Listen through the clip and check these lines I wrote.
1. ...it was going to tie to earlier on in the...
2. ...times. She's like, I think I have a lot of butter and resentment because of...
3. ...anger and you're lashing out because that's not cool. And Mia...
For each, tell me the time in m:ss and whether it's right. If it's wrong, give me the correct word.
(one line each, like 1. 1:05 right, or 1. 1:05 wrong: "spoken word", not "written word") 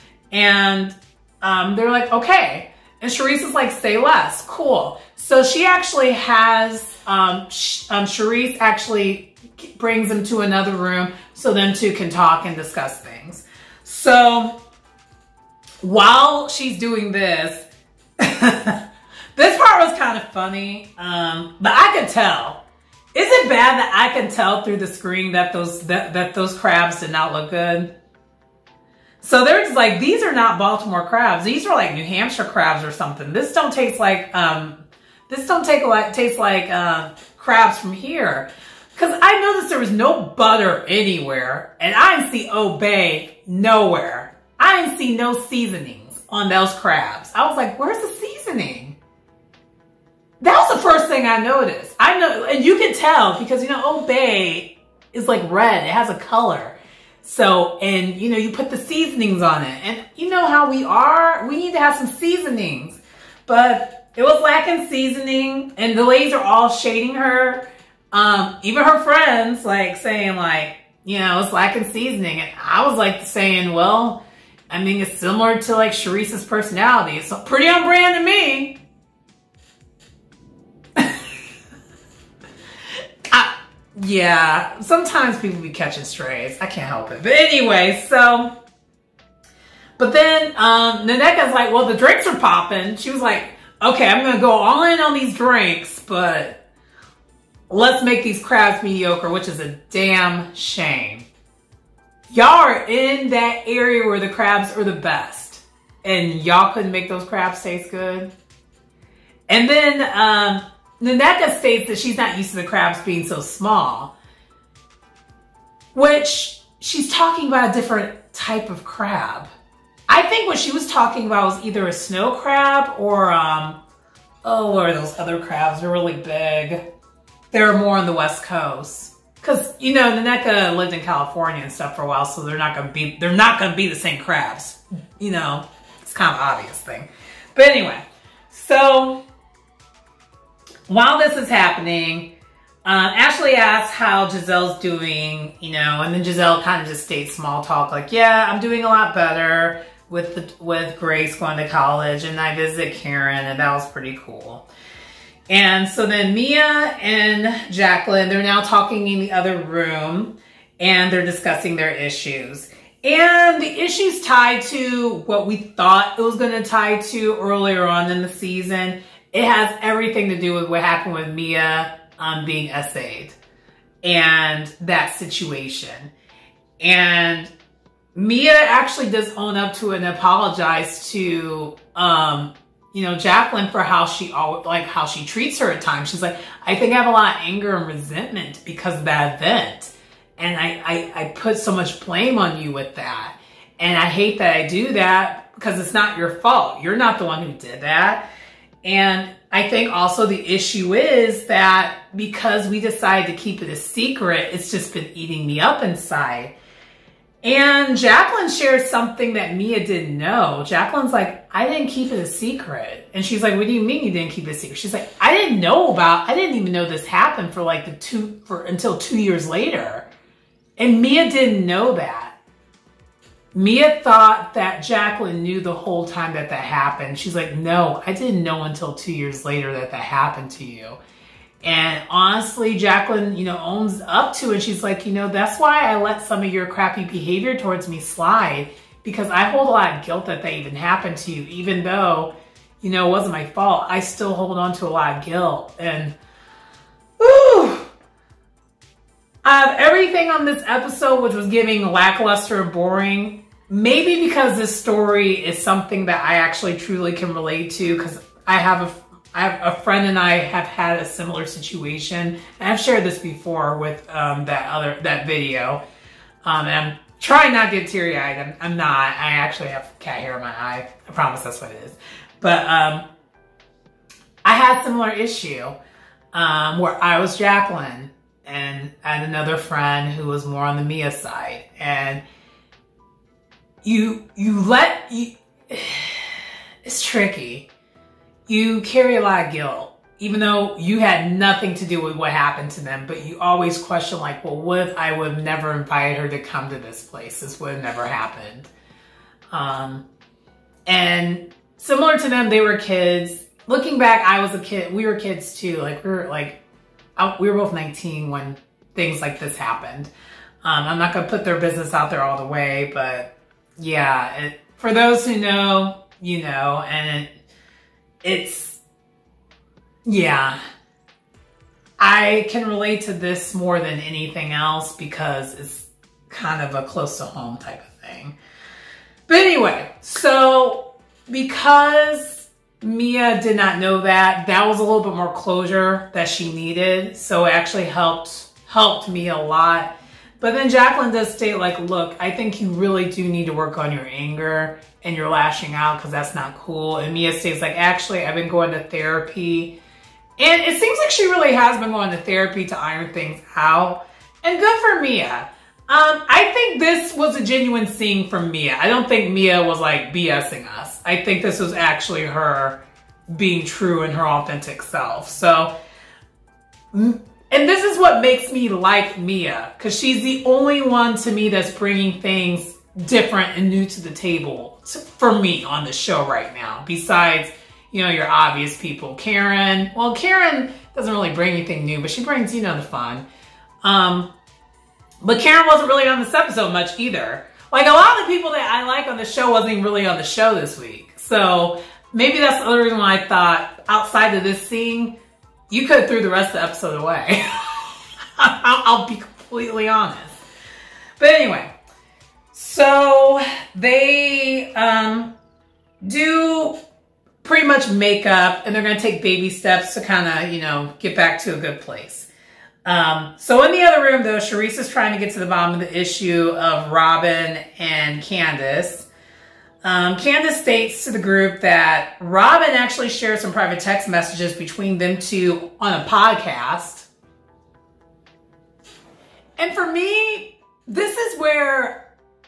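1. 2:46 right
2. 3:05 wrong: "anger", not "butter"
3. 5:44 right.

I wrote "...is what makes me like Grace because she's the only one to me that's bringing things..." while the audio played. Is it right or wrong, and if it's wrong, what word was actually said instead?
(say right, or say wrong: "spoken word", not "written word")
wrong: "Mia", not "Grace".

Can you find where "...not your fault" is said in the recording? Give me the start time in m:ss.
3:15.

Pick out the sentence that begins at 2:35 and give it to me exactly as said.
And so then Mia and Jacqueline, they're now talking in the other room and they're discussing their issues.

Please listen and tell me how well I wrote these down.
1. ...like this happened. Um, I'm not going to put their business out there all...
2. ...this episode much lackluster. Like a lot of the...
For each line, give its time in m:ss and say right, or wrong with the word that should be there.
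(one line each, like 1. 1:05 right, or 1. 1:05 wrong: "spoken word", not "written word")
1. 5:09 right
2. 6:26 wrong: "either", not "lackluster".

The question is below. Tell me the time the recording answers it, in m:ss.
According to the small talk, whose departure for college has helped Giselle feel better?
2:30.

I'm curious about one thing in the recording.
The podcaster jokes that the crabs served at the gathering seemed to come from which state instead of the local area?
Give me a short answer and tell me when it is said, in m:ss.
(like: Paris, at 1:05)
New Hampshire, at 0:31.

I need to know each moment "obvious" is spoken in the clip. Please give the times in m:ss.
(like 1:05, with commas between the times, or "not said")
2:16, 6:18.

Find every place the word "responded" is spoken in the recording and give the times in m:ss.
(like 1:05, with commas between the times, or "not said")
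not said.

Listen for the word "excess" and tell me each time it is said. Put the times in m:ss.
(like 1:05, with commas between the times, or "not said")
not said.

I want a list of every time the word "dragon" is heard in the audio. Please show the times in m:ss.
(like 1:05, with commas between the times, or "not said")
not said.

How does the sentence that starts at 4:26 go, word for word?
Um, and I'm trying not to get teary eyed.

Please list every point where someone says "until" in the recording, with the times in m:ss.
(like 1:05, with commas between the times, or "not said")
3:38, 3:48.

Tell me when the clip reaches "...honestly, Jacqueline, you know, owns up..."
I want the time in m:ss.
3:52.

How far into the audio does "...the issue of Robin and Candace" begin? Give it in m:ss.
6:55.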